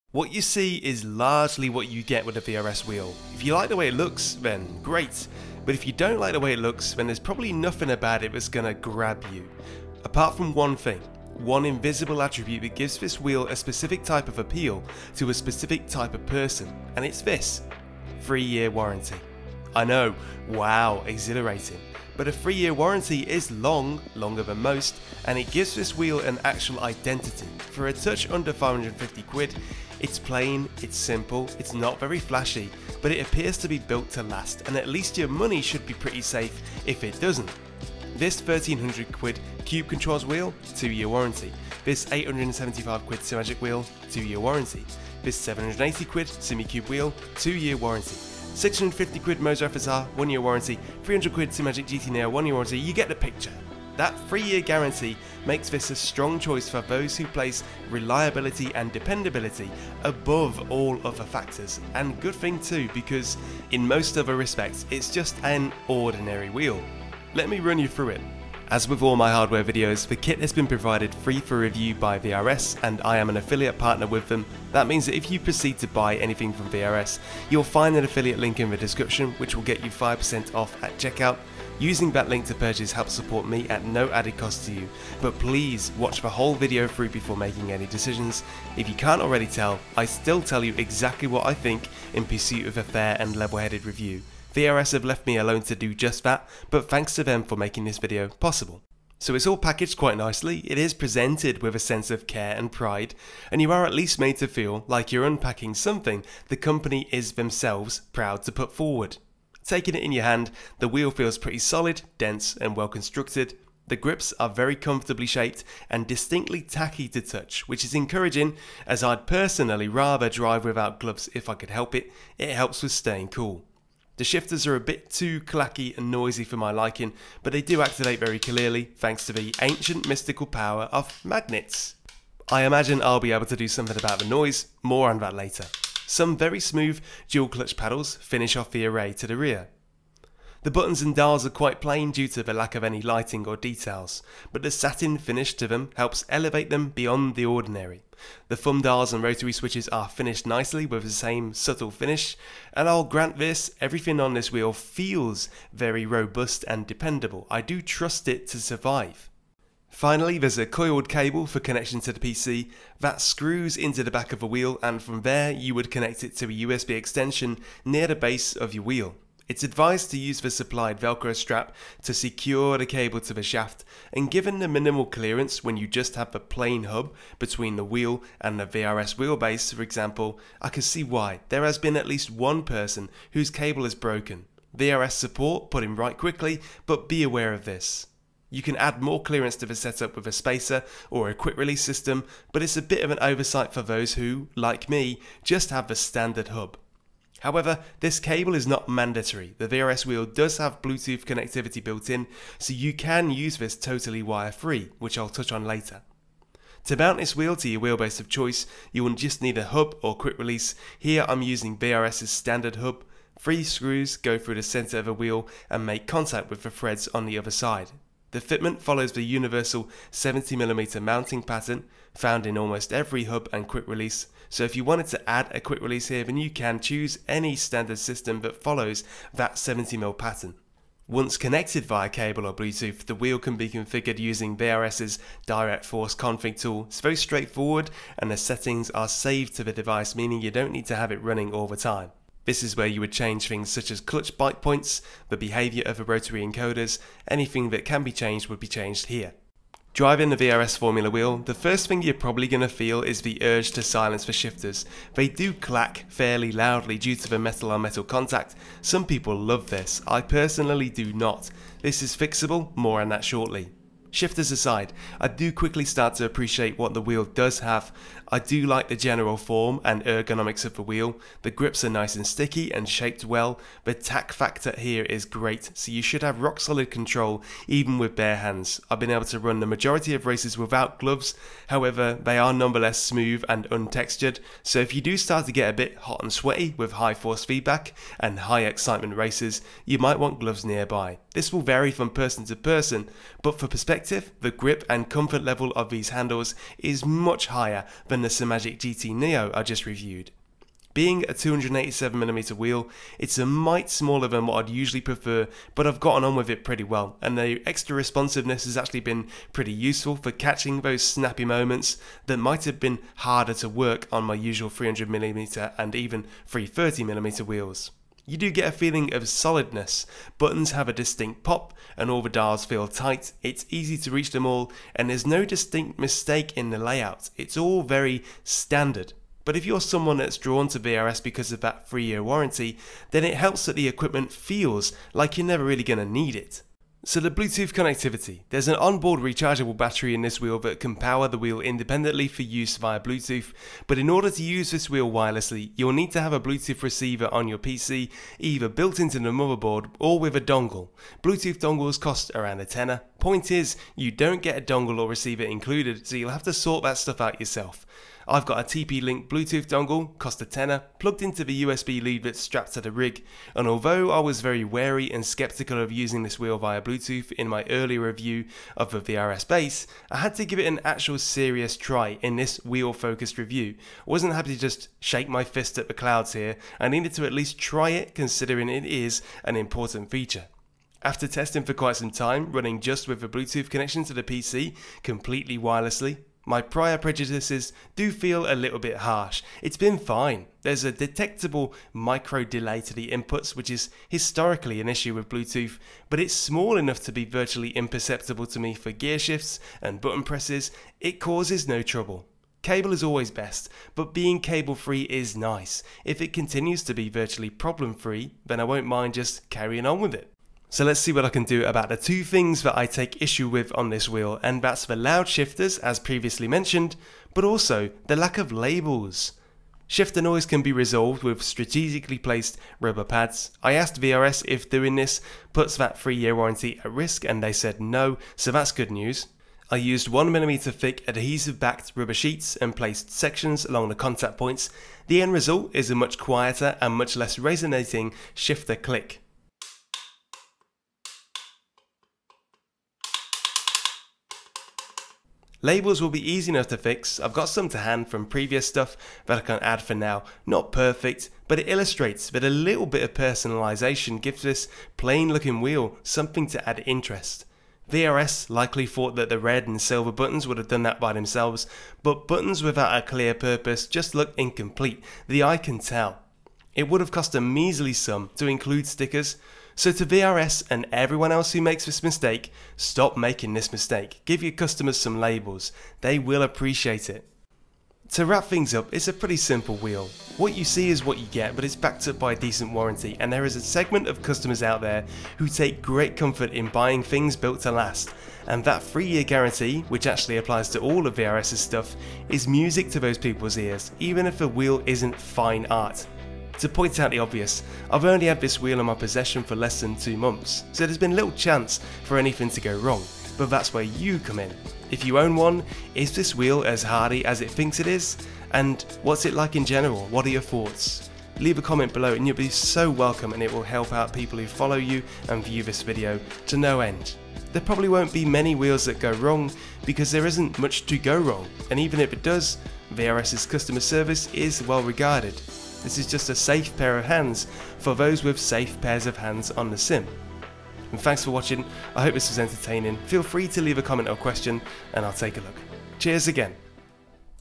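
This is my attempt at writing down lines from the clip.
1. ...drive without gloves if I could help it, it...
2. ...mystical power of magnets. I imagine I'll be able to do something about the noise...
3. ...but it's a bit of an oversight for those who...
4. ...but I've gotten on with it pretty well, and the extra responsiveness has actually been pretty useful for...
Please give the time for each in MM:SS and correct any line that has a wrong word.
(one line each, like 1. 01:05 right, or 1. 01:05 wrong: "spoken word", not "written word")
1. 02:00 right
2. 02:10 right
3. 03:12 right
4. 05:05 right.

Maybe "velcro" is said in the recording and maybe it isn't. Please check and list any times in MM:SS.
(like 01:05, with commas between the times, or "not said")
02:51.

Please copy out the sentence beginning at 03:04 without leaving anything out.
VRS support put in right quickly but be aware of this.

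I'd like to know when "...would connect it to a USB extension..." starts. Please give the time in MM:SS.
02:45.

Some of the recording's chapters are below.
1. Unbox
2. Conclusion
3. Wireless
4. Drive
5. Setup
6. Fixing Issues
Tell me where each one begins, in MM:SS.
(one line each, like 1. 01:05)
1. 01:39
2. 07:57
3. 05:37
4. 04:09
5. 02:40
6. 06:50.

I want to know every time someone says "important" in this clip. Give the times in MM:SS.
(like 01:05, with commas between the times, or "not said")
06:19.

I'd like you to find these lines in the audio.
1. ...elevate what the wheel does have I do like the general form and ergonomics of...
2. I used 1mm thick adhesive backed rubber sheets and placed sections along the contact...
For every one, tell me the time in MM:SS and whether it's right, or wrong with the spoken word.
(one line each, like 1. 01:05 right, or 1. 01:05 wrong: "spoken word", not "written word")
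1. 04:26 wrong: "appreciate", not "elevate"
2. 07:09 right.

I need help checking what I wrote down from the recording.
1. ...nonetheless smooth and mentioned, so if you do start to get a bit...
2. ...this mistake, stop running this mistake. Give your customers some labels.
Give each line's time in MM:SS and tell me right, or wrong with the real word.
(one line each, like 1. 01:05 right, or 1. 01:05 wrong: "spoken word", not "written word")
1. 04:42 wrong: "untextured", not "mentioned"
2. 07:51 wrong: "making", not "running".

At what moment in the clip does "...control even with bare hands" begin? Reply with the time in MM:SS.
04:36.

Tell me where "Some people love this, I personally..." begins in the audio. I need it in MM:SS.
04:18.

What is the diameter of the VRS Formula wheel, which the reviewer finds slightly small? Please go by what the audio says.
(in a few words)
287mm.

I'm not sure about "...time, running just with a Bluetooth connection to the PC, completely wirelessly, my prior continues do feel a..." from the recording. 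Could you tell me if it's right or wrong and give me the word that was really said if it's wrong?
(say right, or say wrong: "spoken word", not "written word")
wrong: "prejudices", not "continues".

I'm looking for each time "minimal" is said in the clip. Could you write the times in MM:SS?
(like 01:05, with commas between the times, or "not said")
02:54.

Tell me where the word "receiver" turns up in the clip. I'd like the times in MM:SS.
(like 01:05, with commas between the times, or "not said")
05:46, 05:55.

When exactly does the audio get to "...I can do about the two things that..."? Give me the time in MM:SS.
06:51.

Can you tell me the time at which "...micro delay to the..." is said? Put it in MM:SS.
06:31.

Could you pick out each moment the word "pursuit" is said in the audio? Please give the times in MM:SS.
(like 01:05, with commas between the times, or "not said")
01:32.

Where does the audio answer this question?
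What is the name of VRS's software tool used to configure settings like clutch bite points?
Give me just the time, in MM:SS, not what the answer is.
03:55.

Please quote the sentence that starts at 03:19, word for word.
The VRS wheel does have Bluetooth connectivity built in, so you can use this totally wire-free, which I'll touch on later.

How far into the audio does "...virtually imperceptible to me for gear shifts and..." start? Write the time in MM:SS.
06:37.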